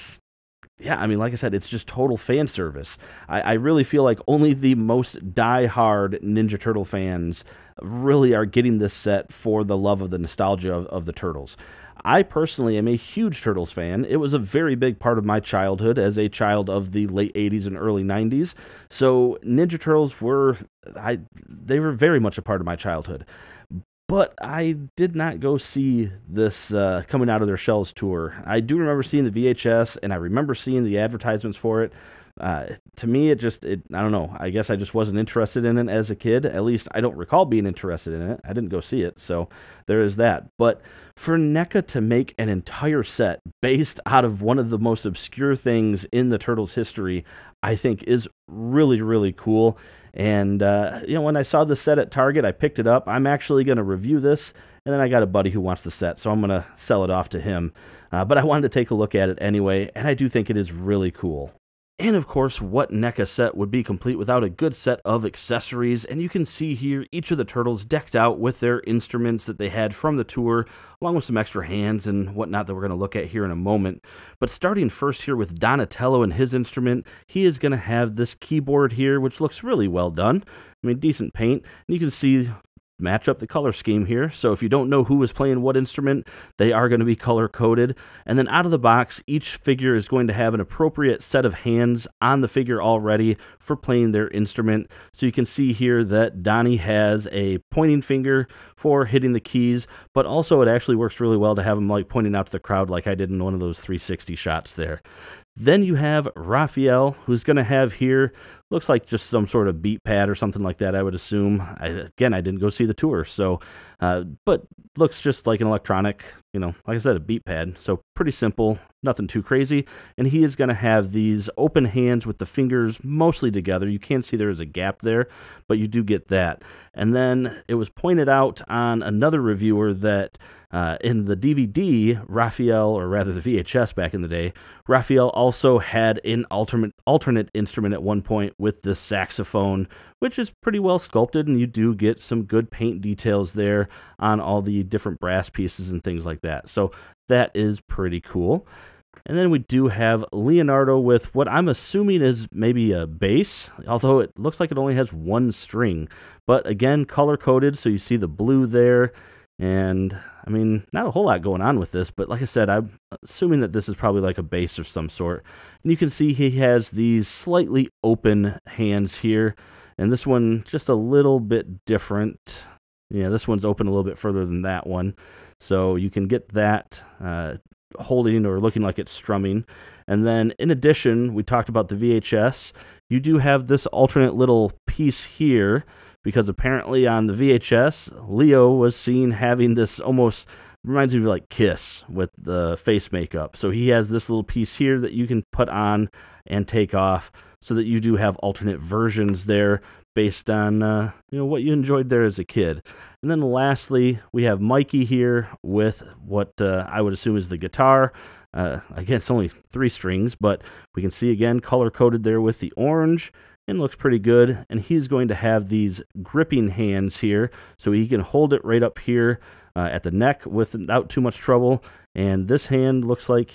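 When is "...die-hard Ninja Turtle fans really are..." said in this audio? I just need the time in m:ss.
0:05.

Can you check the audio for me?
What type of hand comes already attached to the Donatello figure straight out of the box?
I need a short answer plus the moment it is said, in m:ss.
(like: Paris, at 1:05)
Pointing finger, at 1:37.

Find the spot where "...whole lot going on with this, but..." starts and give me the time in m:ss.
2:41.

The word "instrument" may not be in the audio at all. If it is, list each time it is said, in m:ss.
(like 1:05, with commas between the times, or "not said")
1:08, 1:16, 1:25, 1:34, 2:17.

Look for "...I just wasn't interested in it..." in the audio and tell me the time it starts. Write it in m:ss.
0:34.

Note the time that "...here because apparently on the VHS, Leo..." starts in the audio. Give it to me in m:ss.
3:05.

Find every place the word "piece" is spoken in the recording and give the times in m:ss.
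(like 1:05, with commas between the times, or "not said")
2:25, 3:04, 3:14.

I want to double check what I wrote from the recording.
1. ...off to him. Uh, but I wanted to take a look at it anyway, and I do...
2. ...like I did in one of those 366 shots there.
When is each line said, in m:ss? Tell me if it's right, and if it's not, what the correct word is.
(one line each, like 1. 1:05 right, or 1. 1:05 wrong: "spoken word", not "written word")
1. 0:57 right
2. 1:42 wrong: "360", not "366".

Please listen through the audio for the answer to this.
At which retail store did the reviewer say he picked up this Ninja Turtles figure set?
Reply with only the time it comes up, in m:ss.
0:52.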